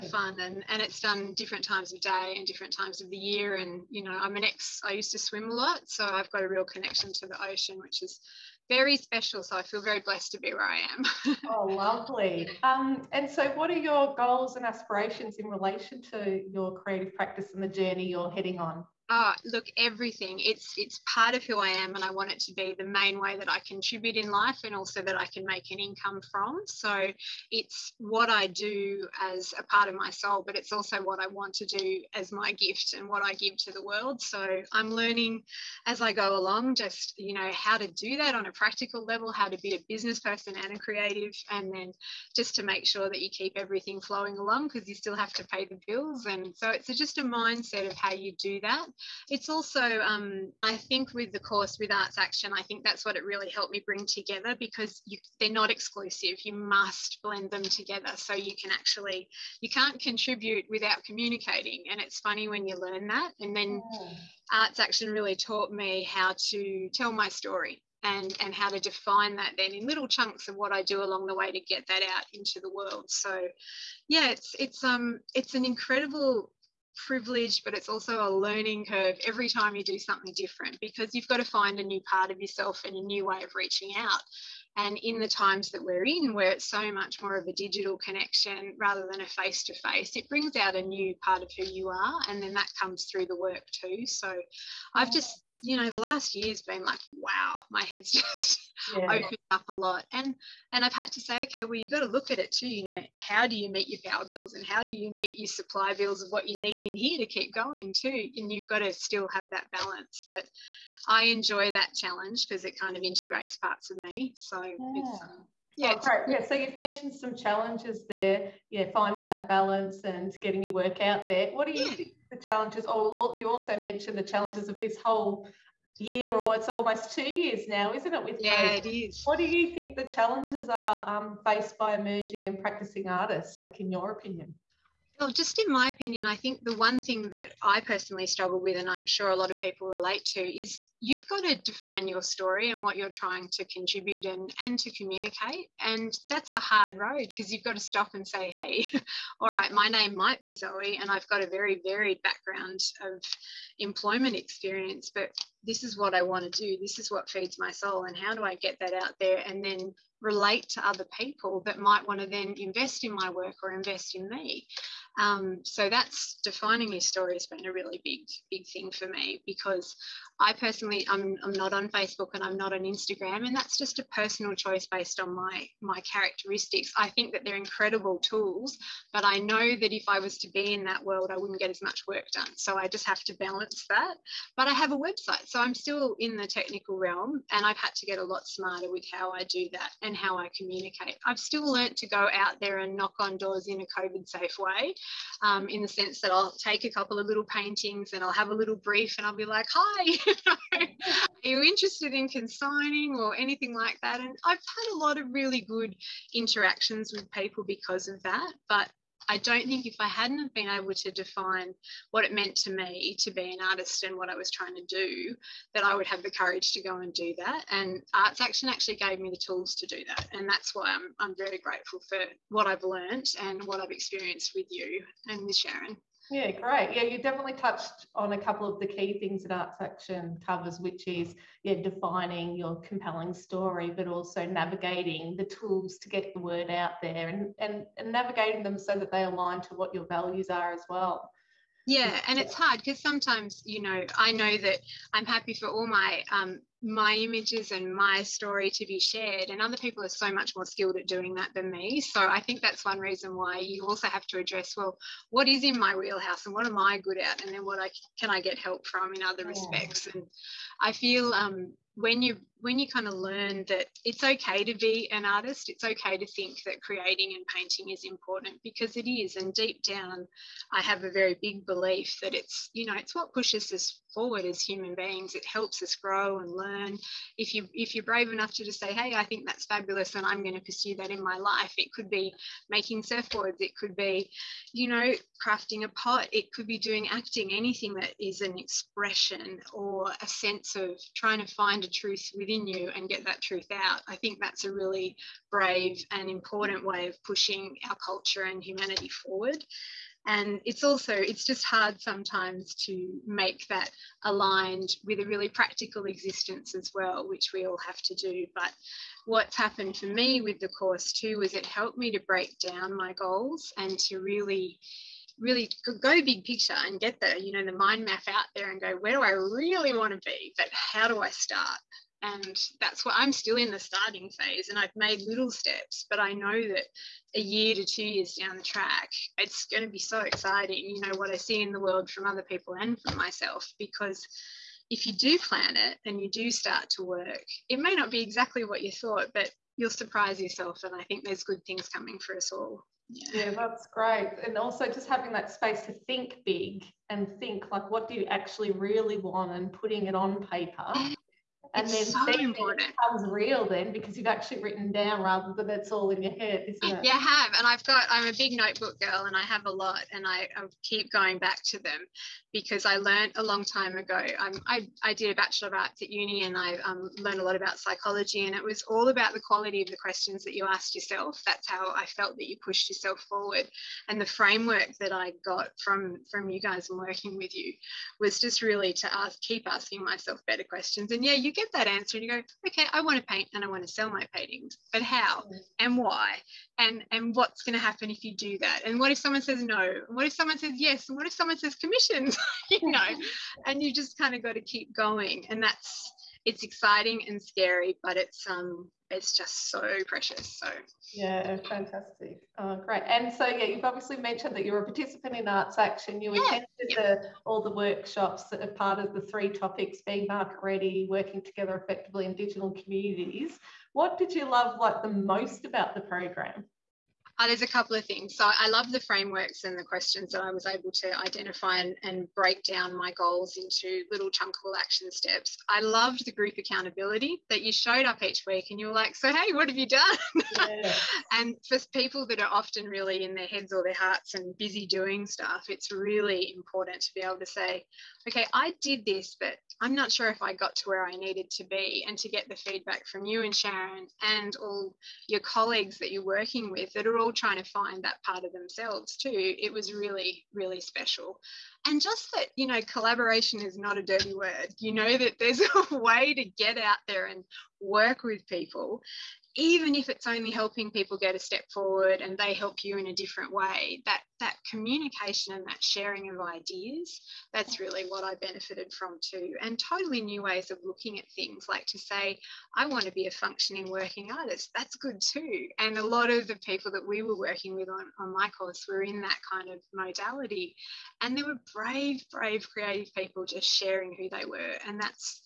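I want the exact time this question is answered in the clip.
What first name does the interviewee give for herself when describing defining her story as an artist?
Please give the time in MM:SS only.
02:30.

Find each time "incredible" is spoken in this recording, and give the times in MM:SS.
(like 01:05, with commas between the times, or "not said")
01:15, 02:57.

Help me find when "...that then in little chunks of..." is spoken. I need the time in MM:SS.
01:09.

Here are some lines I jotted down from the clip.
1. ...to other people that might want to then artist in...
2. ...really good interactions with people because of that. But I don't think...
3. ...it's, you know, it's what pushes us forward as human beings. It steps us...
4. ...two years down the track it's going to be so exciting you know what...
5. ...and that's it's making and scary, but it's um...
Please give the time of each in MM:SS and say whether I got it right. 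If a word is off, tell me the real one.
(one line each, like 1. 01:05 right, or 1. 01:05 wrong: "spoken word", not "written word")
1. 02:40 wrong: "invest", not "artist"
2. 03:25 right
3. 04:32 wrong: "helps", not "steps"
4. 05:27 right
5. 06:35 wrong: "exciting", not "making".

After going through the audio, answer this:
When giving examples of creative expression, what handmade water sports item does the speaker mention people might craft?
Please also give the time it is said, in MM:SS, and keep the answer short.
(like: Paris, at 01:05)
surfboards, at 04:43.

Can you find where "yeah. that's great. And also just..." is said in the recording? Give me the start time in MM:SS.
05:43.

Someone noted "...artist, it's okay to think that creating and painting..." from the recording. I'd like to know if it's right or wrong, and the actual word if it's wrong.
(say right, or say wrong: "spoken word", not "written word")
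right.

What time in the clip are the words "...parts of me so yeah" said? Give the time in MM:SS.
01:53.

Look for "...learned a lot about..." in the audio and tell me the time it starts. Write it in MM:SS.
06:07.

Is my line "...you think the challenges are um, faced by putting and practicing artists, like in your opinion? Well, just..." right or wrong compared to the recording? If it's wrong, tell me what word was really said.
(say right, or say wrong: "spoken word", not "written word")
wrong: "emerging", not "putting".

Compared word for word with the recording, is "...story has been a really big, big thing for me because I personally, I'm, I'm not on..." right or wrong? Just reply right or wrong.
right.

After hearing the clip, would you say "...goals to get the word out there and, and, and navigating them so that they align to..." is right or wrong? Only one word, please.
wrong.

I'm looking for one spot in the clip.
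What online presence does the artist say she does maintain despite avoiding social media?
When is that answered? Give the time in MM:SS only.
03:04.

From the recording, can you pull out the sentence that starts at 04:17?
And then what I, can I get help from in other yeah.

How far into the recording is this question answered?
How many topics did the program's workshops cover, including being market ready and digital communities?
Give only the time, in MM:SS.
06:49.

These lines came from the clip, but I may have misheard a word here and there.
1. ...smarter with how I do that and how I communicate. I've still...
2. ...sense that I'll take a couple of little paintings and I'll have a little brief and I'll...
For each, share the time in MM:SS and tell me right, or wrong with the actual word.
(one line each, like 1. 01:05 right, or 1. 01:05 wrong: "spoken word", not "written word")
1. 03:08 right
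2. 03:15 right.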